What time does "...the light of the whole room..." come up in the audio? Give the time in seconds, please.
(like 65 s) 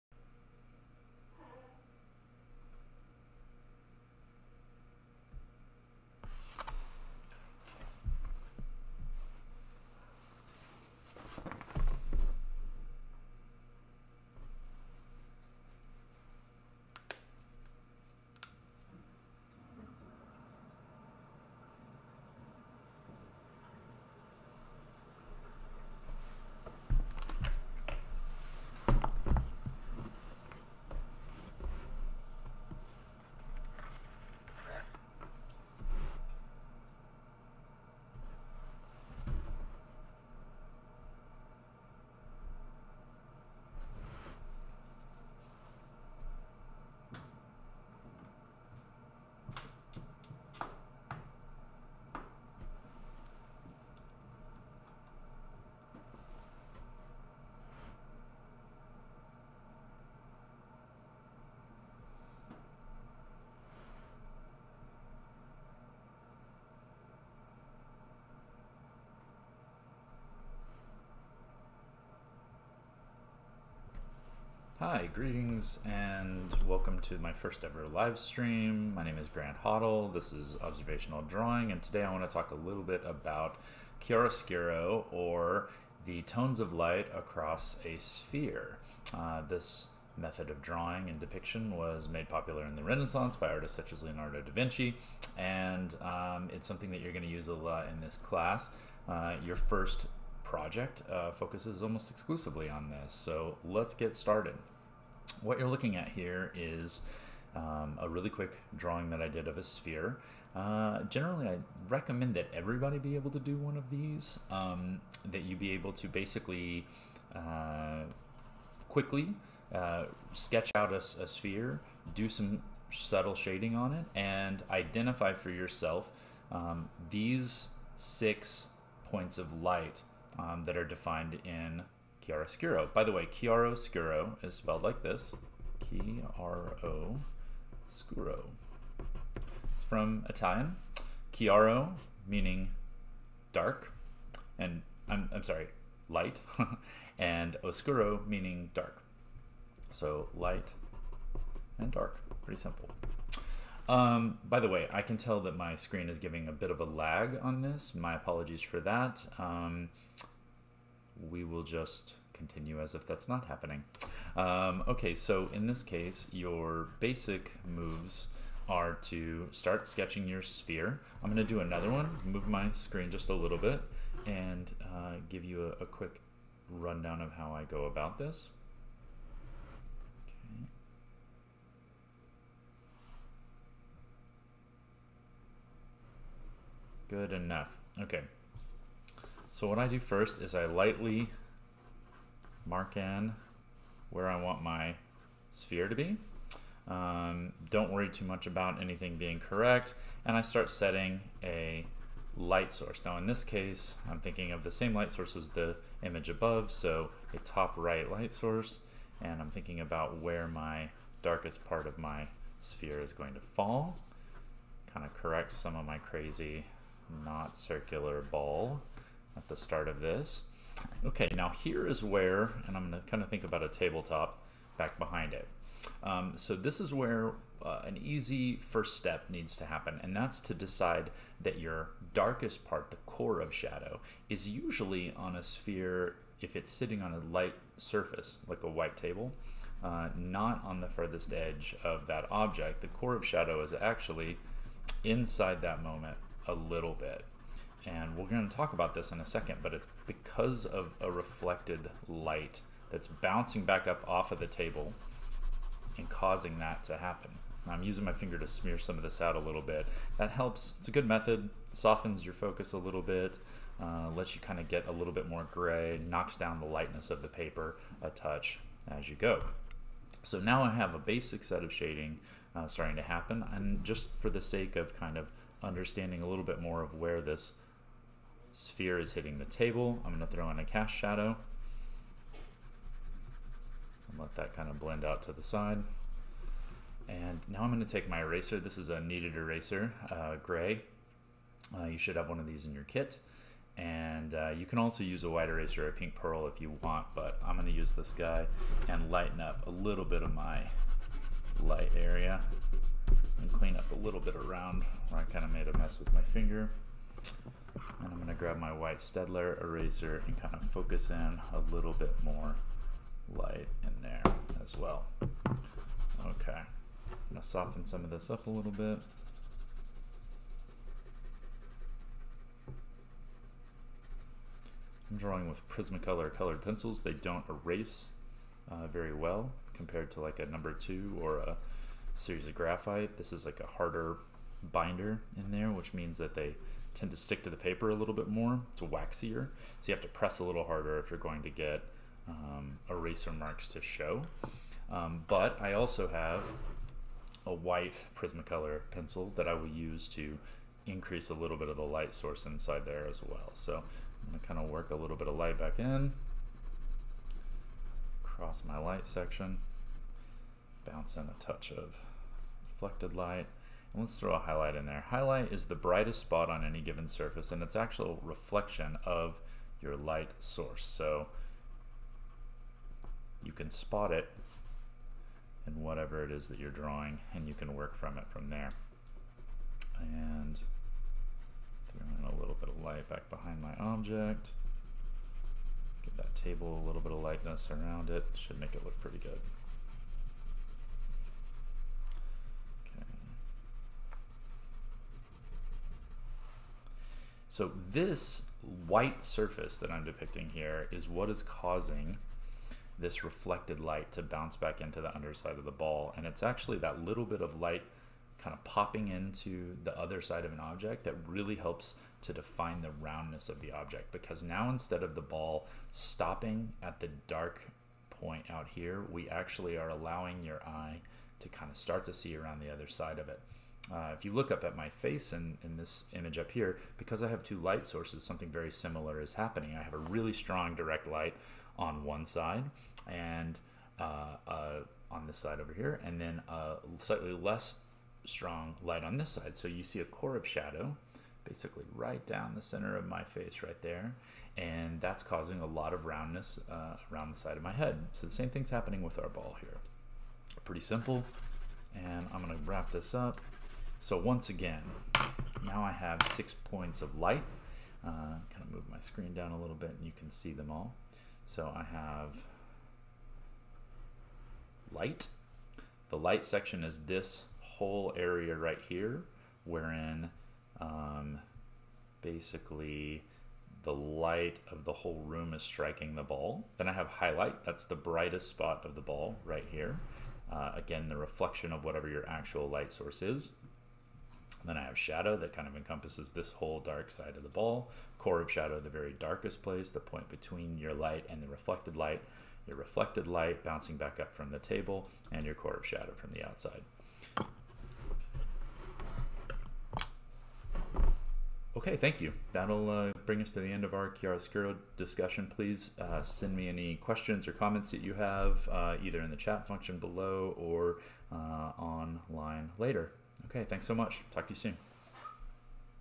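473 s.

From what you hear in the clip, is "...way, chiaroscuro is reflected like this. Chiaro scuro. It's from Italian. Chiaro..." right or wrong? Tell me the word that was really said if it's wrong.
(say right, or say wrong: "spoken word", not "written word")
wrong: "spelled", not "reflected".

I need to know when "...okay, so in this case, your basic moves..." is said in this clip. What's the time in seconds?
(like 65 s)
164 s.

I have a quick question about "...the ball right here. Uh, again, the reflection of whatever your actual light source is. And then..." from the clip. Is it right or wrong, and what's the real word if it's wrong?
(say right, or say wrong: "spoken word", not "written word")
right.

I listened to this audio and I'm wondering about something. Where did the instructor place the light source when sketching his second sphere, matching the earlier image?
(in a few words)
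top right.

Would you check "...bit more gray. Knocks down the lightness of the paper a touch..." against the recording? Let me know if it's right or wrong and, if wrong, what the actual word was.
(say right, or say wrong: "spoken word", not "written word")
right.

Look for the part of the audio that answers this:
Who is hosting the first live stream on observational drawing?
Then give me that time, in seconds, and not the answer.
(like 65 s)
79 s.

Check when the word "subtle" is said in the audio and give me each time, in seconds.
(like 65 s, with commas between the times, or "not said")
122 s.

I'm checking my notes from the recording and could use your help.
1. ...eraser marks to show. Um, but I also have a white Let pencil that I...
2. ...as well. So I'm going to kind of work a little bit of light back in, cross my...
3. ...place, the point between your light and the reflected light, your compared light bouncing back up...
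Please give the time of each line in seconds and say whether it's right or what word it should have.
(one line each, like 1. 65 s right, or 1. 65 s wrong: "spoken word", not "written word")
1. 342 s wrong: "Prismacolor", not "Let"
2. 353 s right
3. 489 s wrong: "reflected", not "compared".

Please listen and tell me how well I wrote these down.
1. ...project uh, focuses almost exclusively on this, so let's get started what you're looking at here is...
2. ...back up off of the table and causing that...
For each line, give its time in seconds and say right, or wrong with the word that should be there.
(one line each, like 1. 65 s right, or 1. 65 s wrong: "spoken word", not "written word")
1. 100 s right
2. 253 s right.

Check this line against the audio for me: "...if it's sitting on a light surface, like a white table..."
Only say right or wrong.
right.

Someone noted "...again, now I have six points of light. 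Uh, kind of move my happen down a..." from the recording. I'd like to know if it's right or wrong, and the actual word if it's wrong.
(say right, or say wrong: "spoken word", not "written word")
wrong: "screen", not "happen".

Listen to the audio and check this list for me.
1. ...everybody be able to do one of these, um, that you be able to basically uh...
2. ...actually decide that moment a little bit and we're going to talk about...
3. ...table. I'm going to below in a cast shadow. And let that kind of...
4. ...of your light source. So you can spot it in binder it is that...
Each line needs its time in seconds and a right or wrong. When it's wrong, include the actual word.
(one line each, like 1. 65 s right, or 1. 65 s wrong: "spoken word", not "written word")
1. 112 s right
2. 243 s wrong: "inside", not "decide"
3. 279 s wrong: "throw", not "below"
4. 369 s wrong: "whatever", not "binder".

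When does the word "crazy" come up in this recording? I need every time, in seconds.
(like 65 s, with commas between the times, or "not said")
215 s.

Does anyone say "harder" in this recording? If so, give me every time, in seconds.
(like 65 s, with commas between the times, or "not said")
333 s, 340 s.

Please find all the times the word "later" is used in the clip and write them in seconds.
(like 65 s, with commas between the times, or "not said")
512 s.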